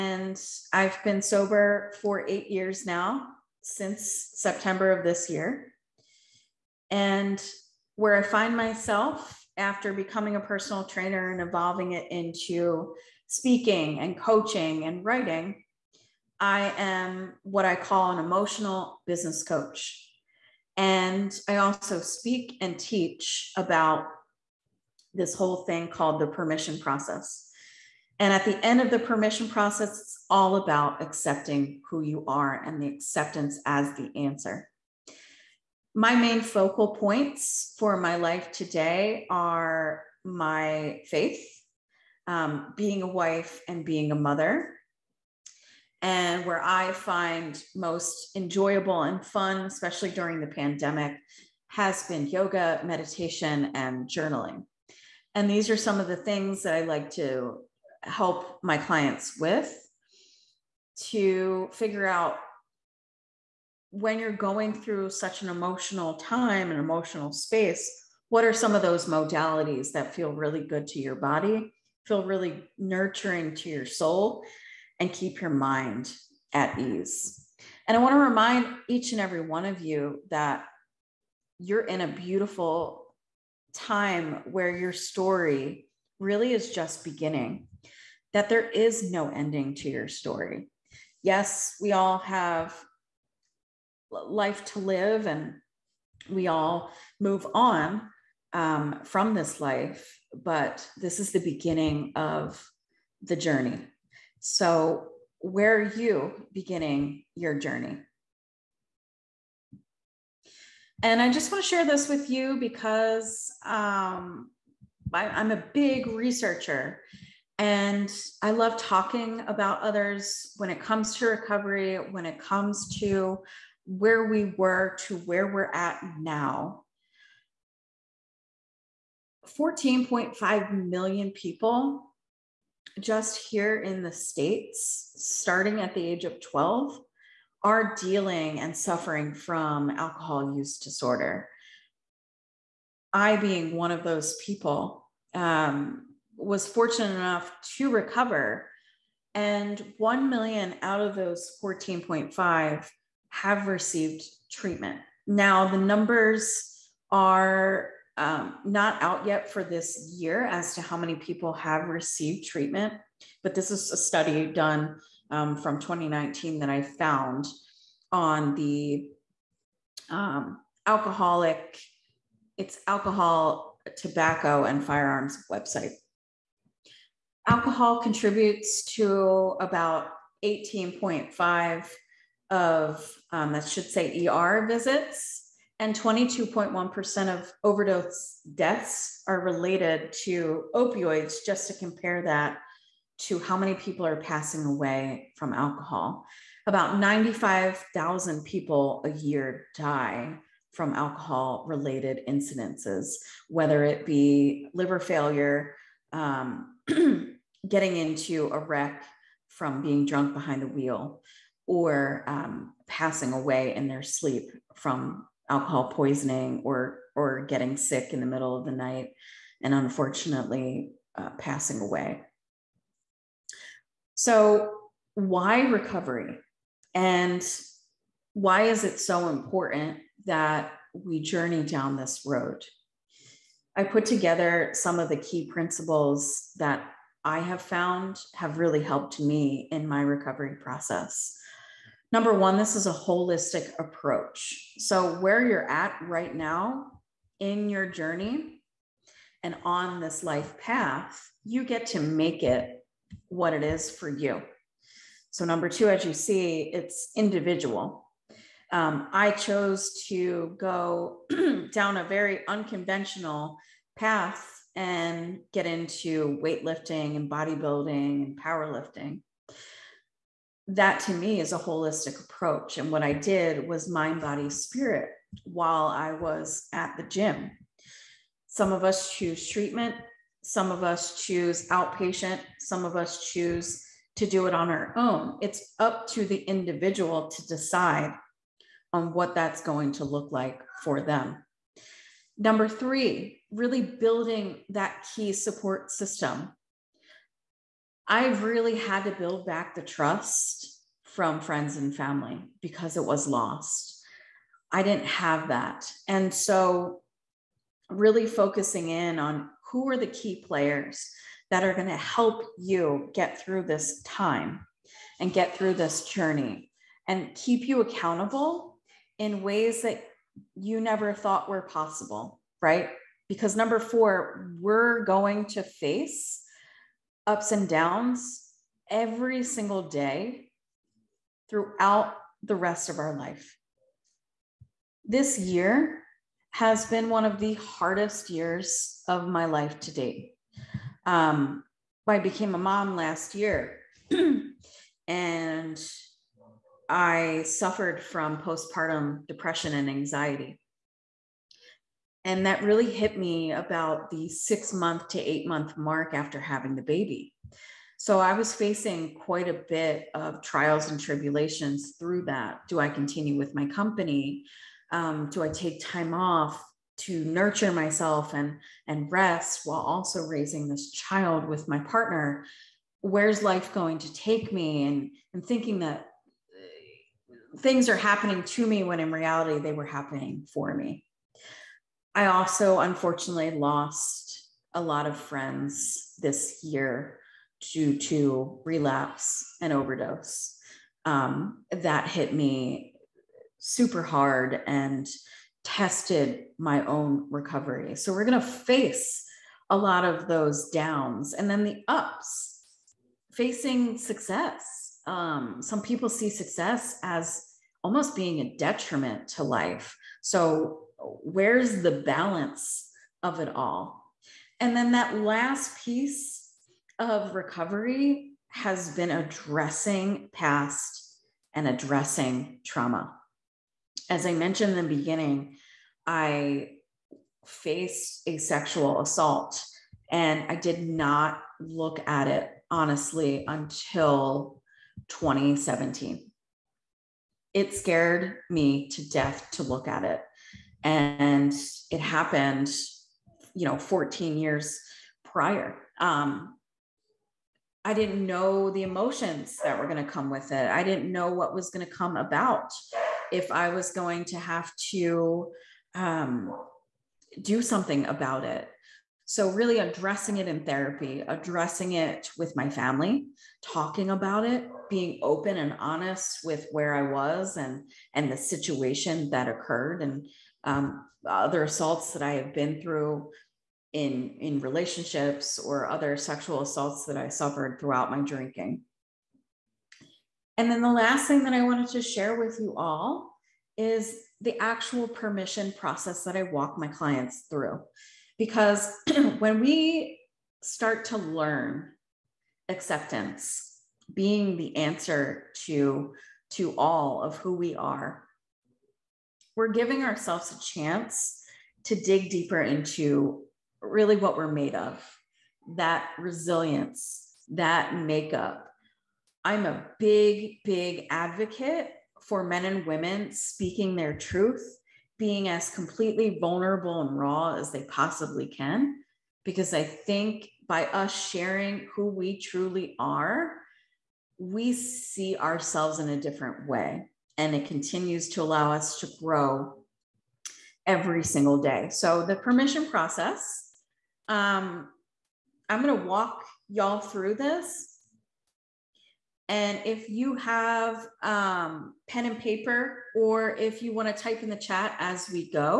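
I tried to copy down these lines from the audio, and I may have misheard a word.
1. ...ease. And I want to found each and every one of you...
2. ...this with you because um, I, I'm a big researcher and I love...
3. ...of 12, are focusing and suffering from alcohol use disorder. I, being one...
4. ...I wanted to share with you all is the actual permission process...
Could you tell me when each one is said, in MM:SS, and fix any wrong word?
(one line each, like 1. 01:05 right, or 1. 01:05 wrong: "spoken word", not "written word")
1. 01:16 wrong: "remind", not "found"
2. 01:51 right
3. 02:16 wrong: "dealing", not "focusing"
4. 08:01 right.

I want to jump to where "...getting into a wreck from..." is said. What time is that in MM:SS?
03:27.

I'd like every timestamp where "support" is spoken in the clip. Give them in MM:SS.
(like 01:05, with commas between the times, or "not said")
04:55.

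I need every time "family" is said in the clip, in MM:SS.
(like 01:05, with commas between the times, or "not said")
05:01, 07:42.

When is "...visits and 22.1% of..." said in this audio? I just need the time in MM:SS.
03:04.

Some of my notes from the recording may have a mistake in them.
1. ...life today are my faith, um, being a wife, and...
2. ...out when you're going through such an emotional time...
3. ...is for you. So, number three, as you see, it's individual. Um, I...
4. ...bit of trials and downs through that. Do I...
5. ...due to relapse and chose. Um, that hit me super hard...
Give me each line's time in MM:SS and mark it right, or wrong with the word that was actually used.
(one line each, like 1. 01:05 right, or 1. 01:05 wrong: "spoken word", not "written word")
1. 00:38 right
2. 01:02 right
3. 04:13 wrong: "two", not "three"
4. 05:59 wrong: "tribulations", not "downs"
5. 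06:27 wrong: "overdose", not "chose".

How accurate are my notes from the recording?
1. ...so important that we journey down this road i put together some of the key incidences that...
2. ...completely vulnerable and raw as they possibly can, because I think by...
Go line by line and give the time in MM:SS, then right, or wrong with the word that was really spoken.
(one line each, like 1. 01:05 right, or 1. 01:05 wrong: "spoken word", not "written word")
1. 03:48 wrong: "principles", not "incidences"
2. 08:35 right.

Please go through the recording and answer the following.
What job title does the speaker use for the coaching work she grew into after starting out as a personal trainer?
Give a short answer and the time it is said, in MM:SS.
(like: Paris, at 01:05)
emotional business coach, at 00:18.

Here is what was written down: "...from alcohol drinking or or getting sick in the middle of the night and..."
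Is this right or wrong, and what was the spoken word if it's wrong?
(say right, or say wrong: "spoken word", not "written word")
wrong: "poisoning", not "drinking".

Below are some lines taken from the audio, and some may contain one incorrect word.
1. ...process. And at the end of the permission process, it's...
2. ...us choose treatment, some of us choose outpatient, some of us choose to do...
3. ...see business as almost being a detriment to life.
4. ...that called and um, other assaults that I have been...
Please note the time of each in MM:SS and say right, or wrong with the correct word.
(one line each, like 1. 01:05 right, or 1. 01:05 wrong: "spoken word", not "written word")
1. 00:26 right
2. 04:38 right
3. 06:46 wrong: "success", not "business"
4. 07:49 wrong: "occurred", not "called".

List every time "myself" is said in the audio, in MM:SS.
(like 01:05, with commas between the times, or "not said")
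00:08, 06:07.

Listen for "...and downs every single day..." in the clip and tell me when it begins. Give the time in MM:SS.
05:27.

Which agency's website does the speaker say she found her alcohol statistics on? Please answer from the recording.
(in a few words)
Alcohol, Tobacco, and Firearms.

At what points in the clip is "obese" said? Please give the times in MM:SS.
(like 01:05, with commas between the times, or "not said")
not said.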